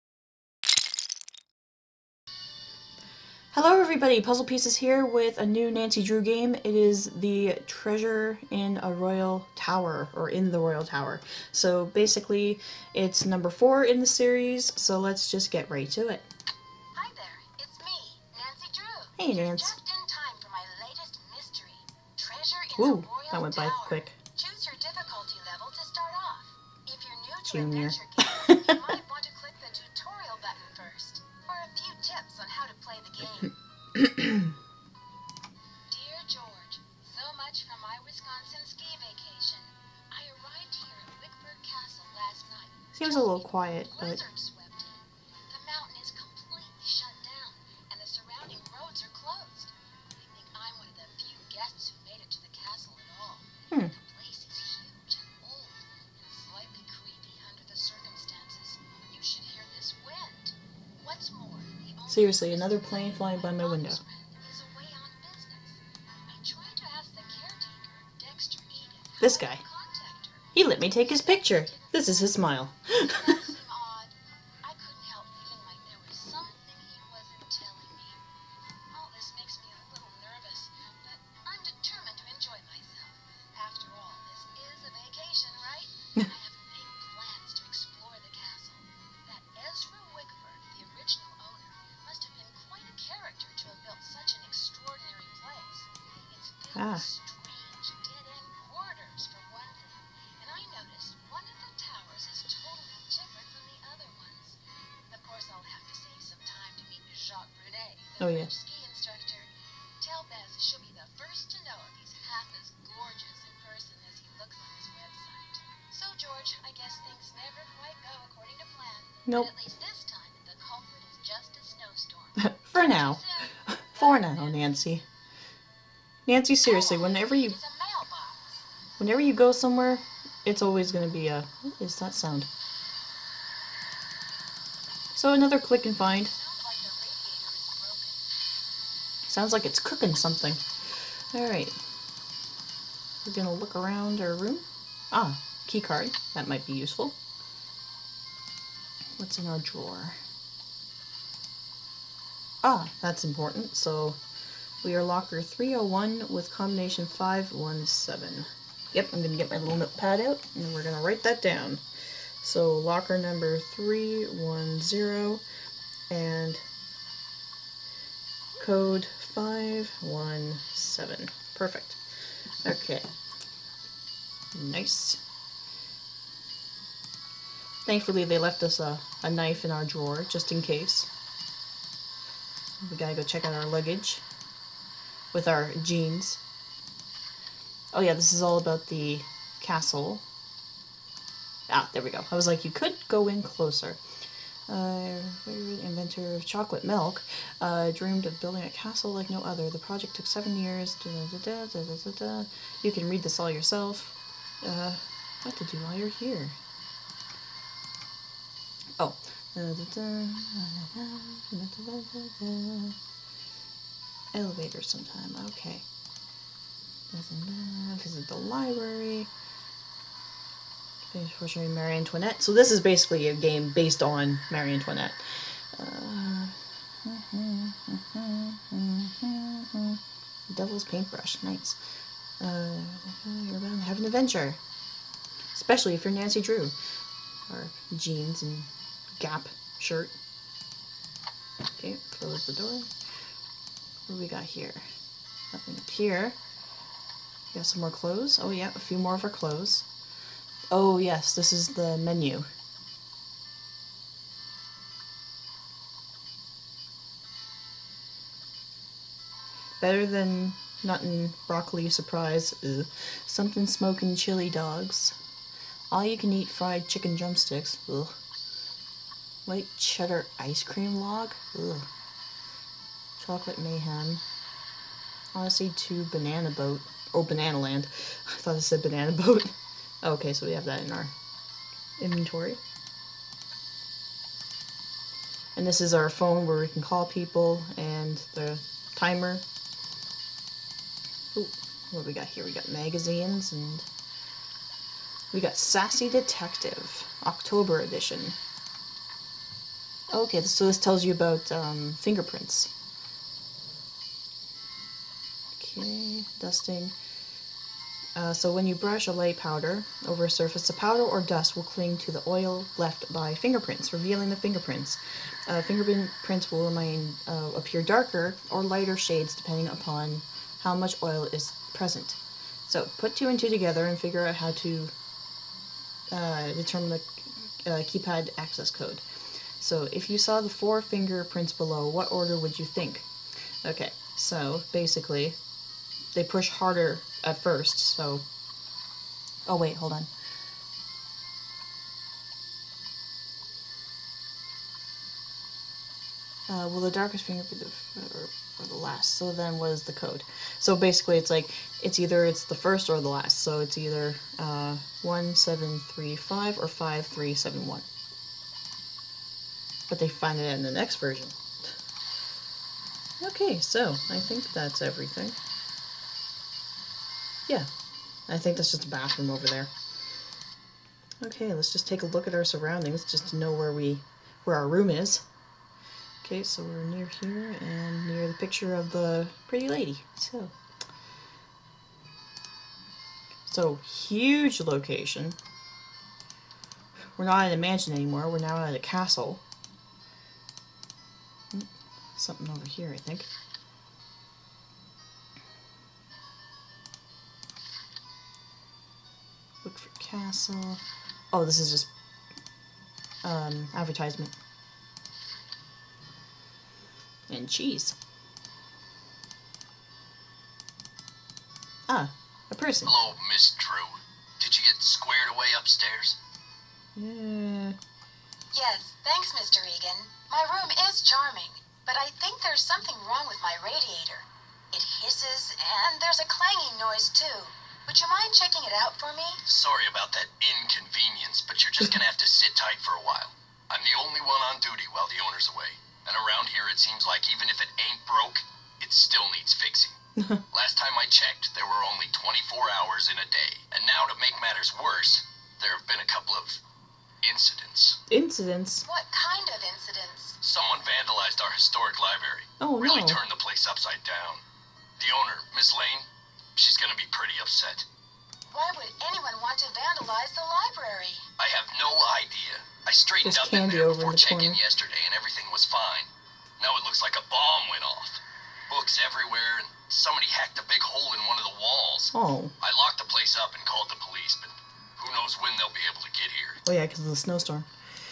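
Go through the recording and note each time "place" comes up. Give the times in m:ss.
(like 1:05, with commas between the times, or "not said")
7:33, 7:53.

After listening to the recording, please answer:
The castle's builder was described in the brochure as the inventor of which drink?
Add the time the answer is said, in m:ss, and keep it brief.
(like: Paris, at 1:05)
chocolate milk, at 3:16.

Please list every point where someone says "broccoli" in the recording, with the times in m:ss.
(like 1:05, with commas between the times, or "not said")
4:21.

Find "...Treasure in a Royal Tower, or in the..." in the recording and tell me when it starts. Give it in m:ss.
0:07.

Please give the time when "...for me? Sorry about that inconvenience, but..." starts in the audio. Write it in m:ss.
7:09.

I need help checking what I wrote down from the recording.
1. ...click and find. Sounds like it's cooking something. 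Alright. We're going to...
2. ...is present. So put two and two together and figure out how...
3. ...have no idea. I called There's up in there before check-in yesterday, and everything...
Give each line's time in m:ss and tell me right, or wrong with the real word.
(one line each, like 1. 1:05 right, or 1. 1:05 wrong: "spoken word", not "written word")
1. 2:15 right
2. 5:21 right
3. 7:41 wrong: "straightened", not "called".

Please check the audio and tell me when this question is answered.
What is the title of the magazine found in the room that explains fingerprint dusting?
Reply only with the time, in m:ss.
4:55.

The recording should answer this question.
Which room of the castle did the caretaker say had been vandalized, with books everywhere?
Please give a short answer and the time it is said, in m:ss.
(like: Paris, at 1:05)
historic library, at 7:31.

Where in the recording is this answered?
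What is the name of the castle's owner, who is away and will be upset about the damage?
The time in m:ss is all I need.
7:35.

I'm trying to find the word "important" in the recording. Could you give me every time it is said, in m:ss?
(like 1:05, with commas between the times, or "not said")
2:33.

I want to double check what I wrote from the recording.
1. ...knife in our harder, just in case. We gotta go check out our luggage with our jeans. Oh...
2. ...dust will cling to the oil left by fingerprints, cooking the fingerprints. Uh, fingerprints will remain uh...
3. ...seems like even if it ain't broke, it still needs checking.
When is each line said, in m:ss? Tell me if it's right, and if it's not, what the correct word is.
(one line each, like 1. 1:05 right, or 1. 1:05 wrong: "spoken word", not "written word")
1. 2:59 wrong: "drawer", not "harder"
2. 5:11 wrong: "revealing", not "cooking"
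3. 7:16 wrong: "fixing", not "checking".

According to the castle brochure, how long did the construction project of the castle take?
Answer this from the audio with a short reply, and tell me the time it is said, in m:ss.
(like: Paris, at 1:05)
seven years, at 3:20.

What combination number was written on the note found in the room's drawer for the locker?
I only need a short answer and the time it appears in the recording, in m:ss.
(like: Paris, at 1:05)
517, at 2:36.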